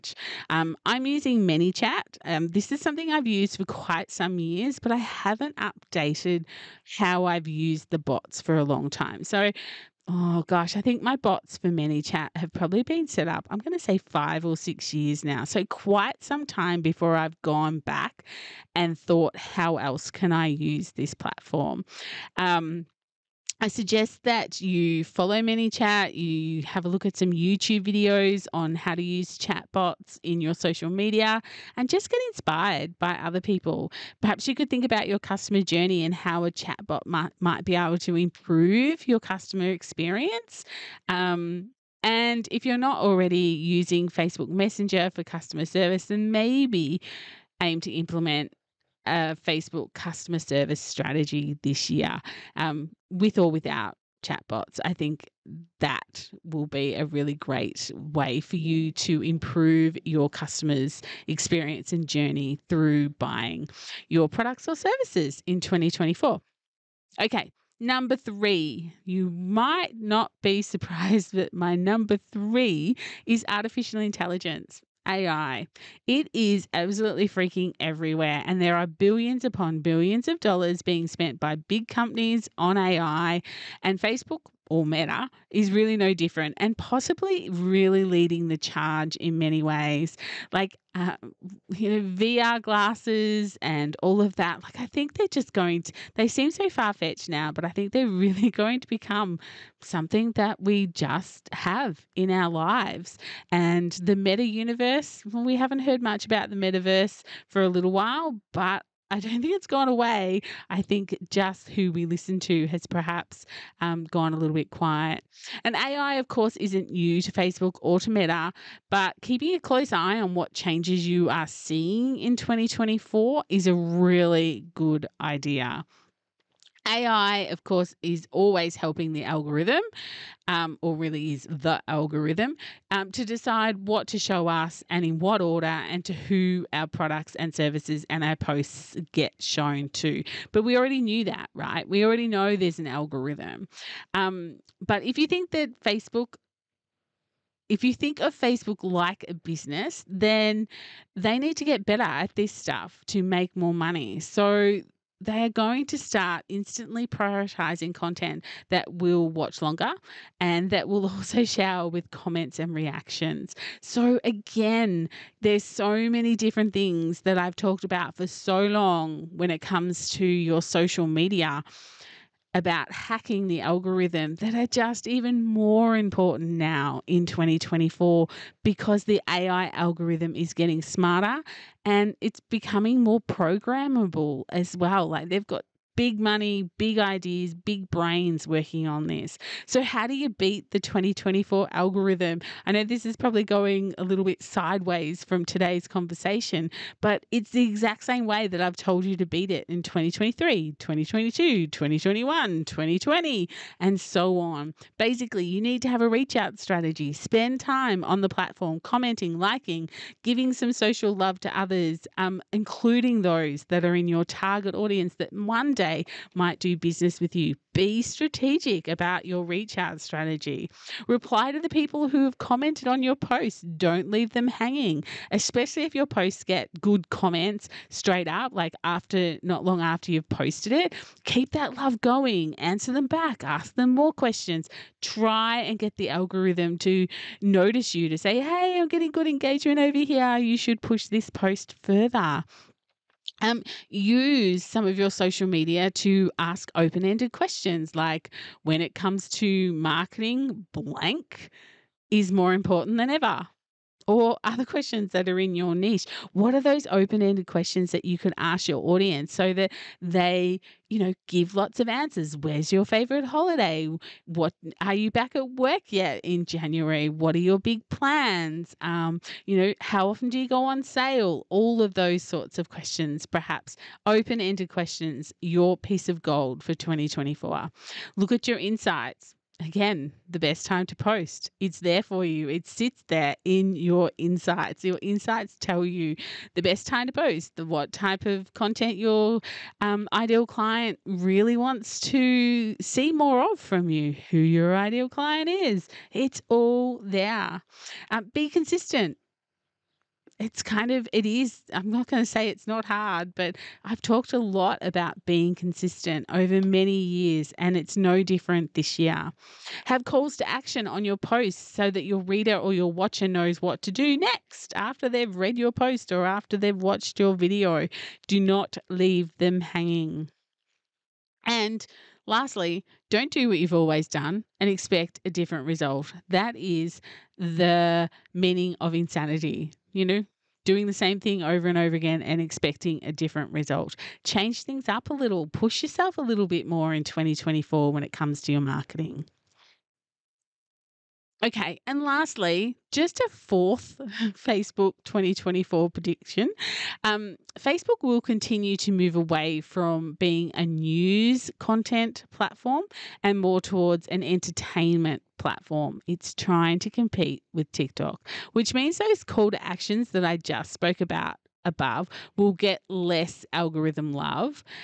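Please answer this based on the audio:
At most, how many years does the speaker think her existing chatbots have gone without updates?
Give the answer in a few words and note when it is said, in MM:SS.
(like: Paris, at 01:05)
6, at 00:14.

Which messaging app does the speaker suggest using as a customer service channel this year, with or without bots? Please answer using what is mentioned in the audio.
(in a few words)
Facebook Messenger.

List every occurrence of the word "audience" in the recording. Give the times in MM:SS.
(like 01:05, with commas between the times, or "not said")
03:34, 04:18.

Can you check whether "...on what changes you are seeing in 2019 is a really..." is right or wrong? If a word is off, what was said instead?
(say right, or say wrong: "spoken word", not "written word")
wrong: "2024", not "2019".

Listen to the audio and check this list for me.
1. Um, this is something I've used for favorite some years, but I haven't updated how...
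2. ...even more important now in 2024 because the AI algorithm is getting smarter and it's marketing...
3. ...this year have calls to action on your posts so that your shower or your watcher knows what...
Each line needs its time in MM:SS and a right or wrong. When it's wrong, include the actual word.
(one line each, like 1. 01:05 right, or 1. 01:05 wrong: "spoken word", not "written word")
1. 00:02 wrong: "quite", not "favorite"
2. 02:55 wrong: "becoming", not "marketing"
3. 05:08 wrong: "reader", not "shower".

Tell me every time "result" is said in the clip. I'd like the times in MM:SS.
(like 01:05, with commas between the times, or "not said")
05:25, 05:33.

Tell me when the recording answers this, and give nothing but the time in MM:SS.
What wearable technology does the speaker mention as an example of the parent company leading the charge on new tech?
01:32.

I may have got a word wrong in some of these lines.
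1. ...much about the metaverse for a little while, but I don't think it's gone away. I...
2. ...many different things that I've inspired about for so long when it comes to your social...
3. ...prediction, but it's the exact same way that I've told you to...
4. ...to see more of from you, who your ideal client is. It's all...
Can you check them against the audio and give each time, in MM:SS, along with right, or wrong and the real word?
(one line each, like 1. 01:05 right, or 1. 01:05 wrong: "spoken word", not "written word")
1. 01:46 right
2. 02:46 wrong: "talked", not "inspired"
3. 03:15 wrong: "conversation", not "prediction"
4. 04:52 right.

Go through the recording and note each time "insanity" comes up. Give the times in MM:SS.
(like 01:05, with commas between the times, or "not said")
05:28.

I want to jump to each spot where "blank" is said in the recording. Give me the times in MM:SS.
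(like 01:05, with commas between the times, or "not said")
04:10.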